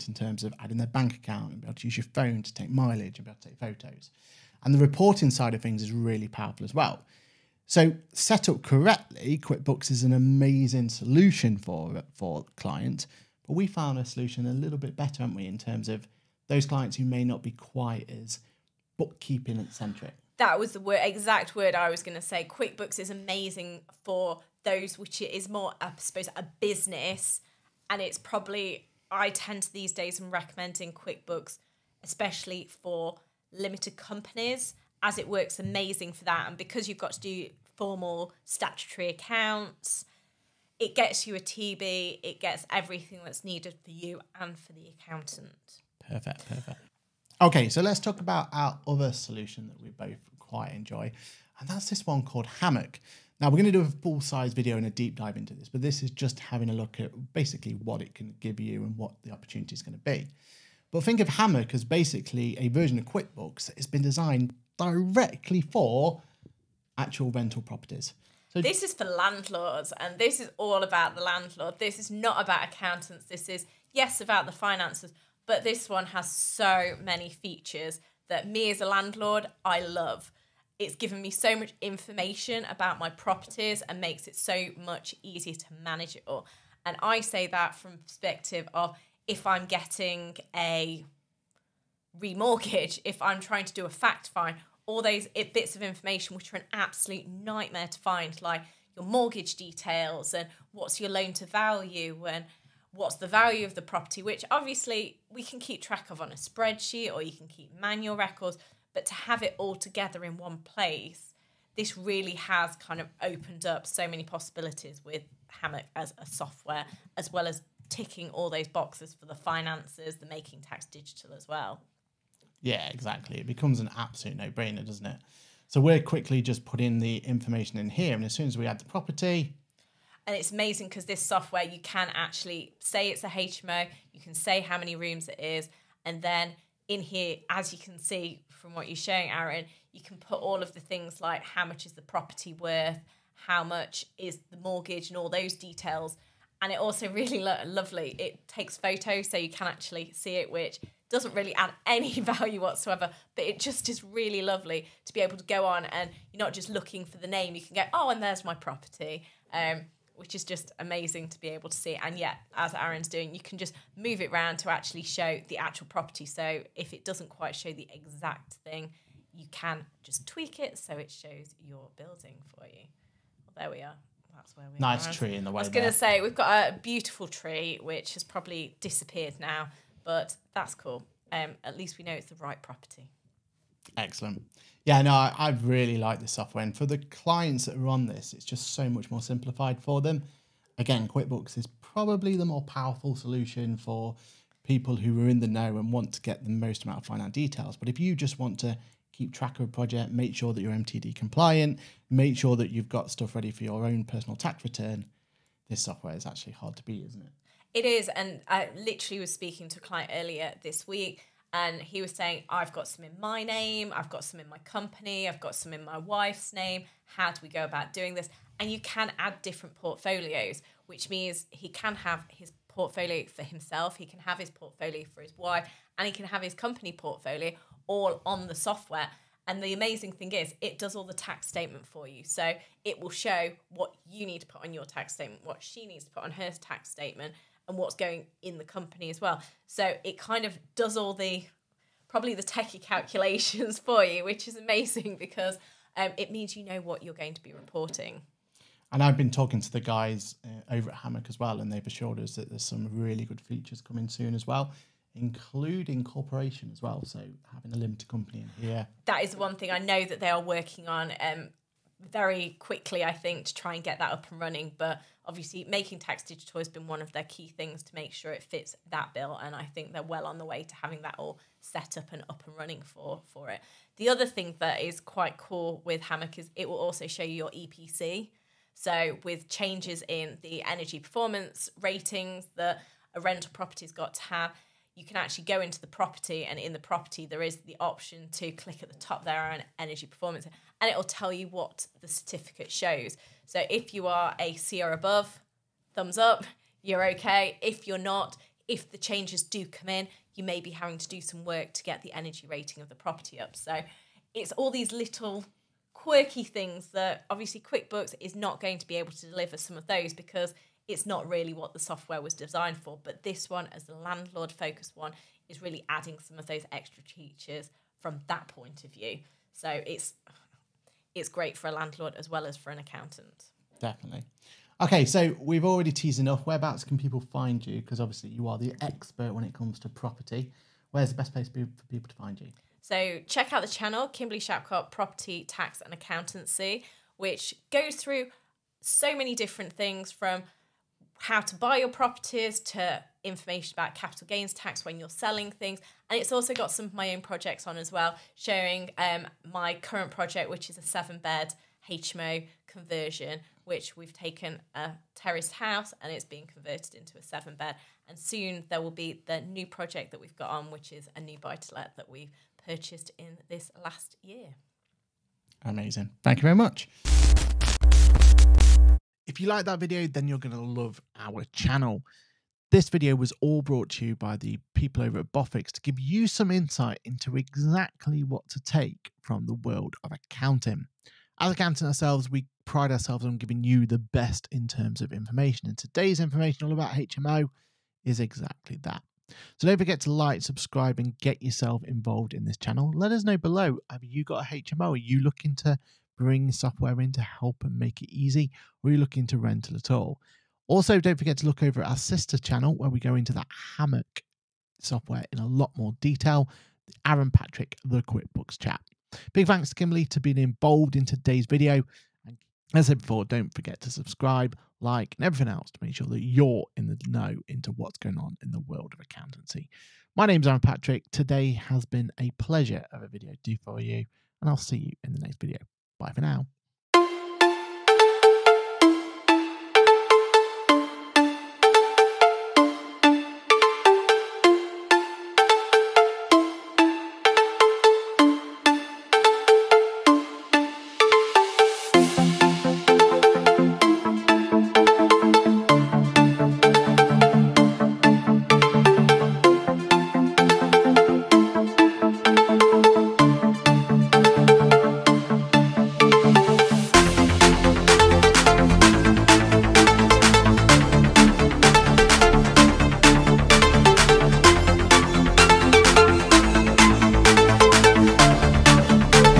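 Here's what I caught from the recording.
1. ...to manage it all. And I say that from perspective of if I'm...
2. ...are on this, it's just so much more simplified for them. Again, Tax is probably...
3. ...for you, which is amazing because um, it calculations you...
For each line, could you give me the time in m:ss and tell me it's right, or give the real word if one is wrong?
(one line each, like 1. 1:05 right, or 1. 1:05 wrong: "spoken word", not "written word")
1. 1:25 right
2. 3:07 wrong: "QuickBooks", not "Tax"
3. 4:03 wrong: "means", not "calculations".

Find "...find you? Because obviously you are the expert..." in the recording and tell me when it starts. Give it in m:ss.
5:27.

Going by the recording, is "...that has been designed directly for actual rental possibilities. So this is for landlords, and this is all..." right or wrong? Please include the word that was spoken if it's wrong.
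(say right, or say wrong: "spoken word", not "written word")
wrong: "properties", not "possibilities".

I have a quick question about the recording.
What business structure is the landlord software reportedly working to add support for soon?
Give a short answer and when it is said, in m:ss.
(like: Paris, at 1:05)
Limited company, at 4:17.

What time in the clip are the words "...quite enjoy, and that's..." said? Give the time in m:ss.
0:50.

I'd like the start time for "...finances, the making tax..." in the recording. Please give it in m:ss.
1:59.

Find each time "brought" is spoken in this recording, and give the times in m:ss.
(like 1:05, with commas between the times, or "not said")
6:13.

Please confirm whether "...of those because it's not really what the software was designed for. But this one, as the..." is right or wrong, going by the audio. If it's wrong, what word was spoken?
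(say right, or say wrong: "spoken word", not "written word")
right.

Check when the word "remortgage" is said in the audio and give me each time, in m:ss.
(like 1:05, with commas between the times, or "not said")
1:32.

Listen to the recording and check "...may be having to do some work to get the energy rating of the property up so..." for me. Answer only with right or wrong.
right.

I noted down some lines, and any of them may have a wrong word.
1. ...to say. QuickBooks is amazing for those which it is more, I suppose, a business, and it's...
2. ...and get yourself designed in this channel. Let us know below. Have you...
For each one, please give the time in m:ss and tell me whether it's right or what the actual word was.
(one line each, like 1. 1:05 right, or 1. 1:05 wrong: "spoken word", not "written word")
1. 0:22 right
2. 6:30 wrong: "involved", not "designed".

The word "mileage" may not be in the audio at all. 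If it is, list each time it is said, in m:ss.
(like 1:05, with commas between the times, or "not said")
0:02.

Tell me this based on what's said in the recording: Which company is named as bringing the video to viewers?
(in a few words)
Boffix.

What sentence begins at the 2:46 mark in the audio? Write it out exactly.
So if it doesn't quite show the exact thing, you can just tweak it so it shows your building for you.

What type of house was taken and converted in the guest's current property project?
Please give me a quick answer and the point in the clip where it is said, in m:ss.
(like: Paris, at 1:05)
Terraced house, at 5:55.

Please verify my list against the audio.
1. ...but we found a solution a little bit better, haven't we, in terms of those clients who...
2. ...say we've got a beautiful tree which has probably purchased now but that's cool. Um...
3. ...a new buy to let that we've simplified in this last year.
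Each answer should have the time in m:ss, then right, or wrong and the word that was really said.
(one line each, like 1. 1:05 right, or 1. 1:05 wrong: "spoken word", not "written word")
1. 0:13 right
2. 2:55 wrong: "disappeared", not "purchased"
3. 6:01 wrong: "purchased", not "simplified".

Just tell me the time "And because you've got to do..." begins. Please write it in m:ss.
0:36.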